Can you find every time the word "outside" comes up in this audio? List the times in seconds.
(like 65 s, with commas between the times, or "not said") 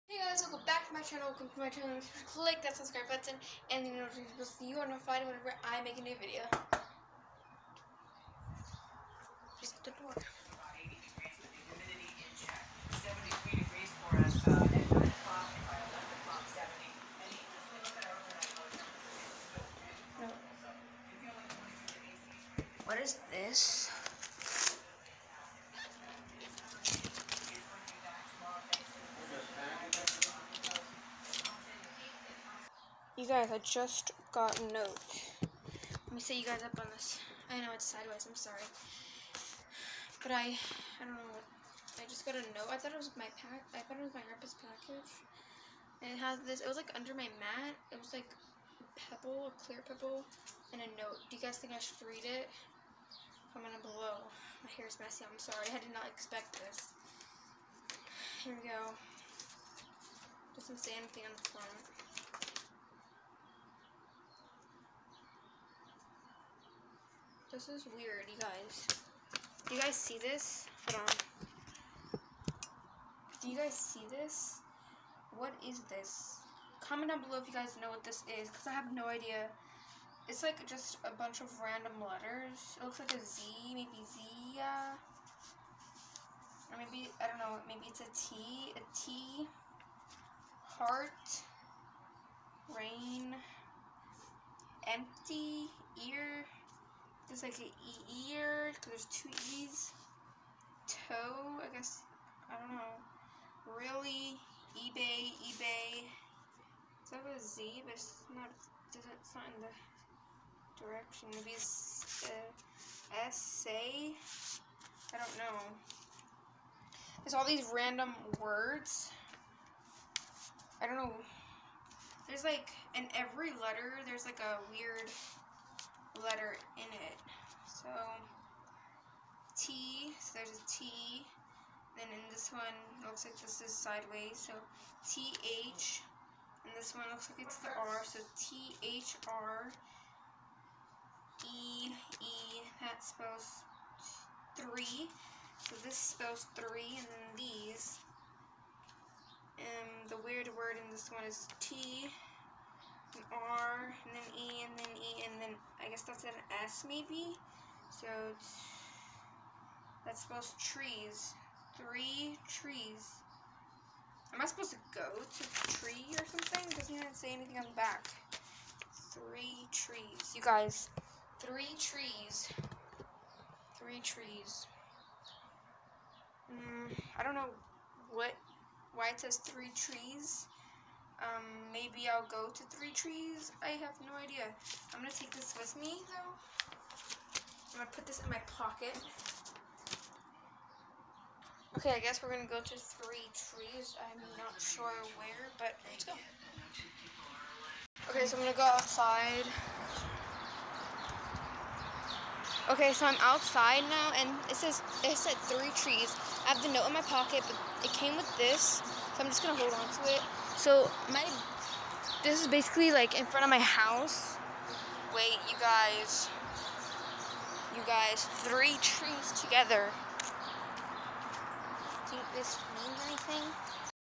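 198 s, 203 s.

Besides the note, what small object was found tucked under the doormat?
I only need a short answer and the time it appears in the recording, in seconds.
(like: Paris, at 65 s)
A clear pebble, at 49 s.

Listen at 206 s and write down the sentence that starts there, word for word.
I have the note in my pocket, but it came with this.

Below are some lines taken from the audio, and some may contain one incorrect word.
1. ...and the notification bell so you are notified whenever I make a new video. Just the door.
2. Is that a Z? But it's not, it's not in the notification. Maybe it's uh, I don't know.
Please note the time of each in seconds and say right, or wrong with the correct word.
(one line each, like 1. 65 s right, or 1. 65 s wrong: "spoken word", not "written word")
1. 3 s right
2. 107 s wrong: "direction", not "notification".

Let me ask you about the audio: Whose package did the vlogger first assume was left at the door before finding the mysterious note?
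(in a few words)
Grandpa's package.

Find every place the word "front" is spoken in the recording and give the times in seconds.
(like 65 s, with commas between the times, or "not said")
61 s, 213 s.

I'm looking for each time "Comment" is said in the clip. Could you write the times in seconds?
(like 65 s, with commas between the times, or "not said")
53 s, 76 s.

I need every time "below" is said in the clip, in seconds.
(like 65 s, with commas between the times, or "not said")
53 s, 77 s.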